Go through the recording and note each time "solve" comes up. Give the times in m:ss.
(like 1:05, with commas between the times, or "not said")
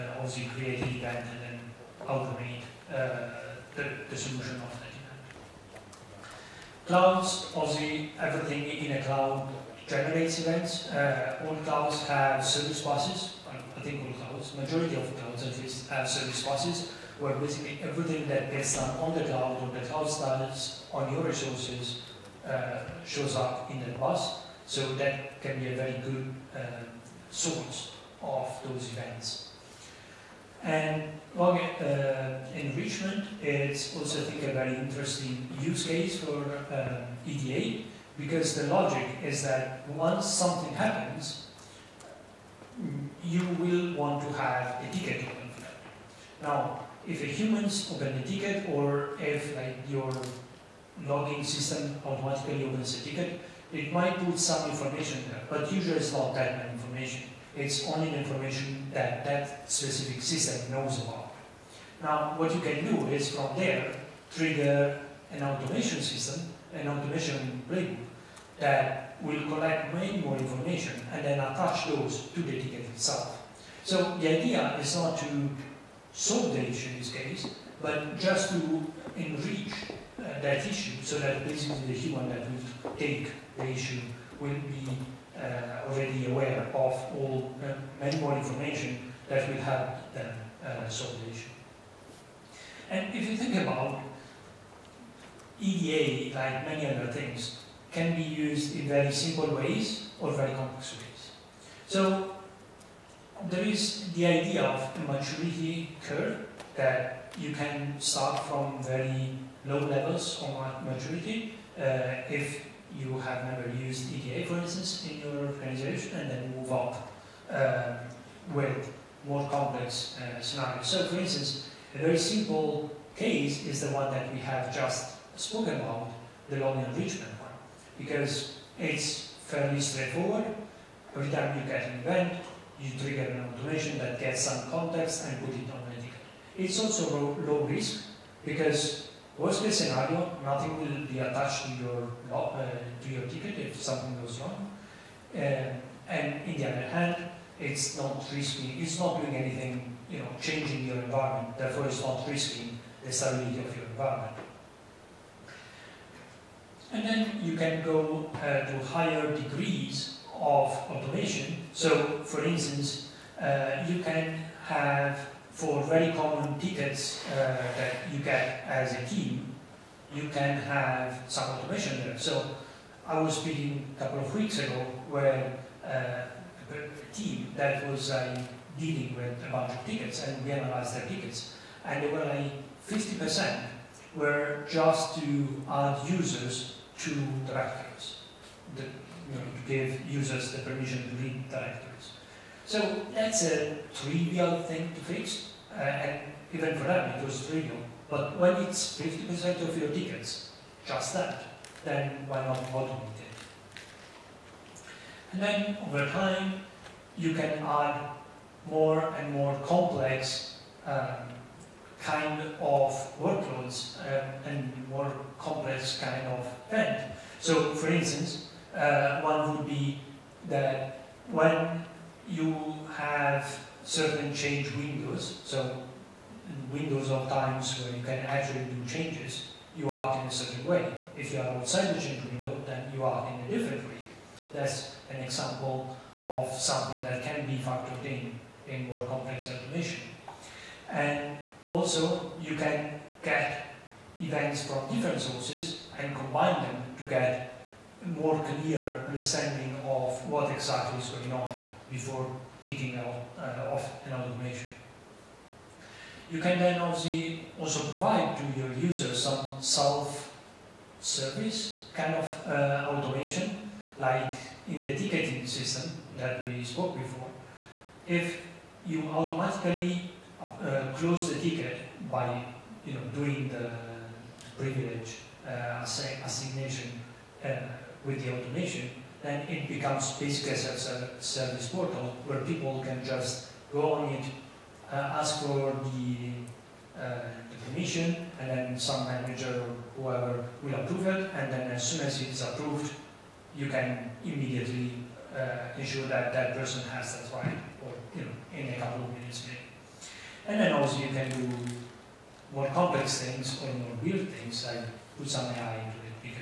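1:16, 1:30.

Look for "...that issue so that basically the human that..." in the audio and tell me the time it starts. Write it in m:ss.
1:20.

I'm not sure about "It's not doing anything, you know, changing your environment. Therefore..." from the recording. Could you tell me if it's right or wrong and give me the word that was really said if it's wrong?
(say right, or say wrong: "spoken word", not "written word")
right.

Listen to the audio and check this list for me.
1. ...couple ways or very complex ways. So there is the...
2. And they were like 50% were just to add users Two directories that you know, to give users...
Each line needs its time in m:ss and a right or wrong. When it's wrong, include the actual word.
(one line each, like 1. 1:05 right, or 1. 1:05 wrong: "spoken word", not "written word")
1. 1:39 wrong: "simple", not "couple"
2. 3:01 right.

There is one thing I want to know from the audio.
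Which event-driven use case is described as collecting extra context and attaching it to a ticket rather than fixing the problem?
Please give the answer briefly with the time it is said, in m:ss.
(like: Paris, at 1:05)
log enrichment, at 0:31.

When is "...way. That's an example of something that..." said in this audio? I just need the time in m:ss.
3:53.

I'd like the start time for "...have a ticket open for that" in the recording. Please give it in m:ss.
0:44.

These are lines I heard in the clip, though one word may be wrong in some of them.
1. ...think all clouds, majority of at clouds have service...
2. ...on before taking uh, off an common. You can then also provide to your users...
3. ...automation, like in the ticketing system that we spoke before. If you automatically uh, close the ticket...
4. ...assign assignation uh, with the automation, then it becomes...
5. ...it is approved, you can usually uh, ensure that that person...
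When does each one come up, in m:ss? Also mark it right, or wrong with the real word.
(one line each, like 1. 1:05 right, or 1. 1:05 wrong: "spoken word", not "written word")
1. 0:13 right
2. 4:11 wrong: "automation", not "common"
3. 4:22 right
4. 4:35 right
5. 4:52 wrong: "immediately", not "usually".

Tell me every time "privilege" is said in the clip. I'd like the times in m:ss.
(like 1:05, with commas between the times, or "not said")
4:34.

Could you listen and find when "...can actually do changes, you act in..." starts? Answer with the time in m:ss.
3:48.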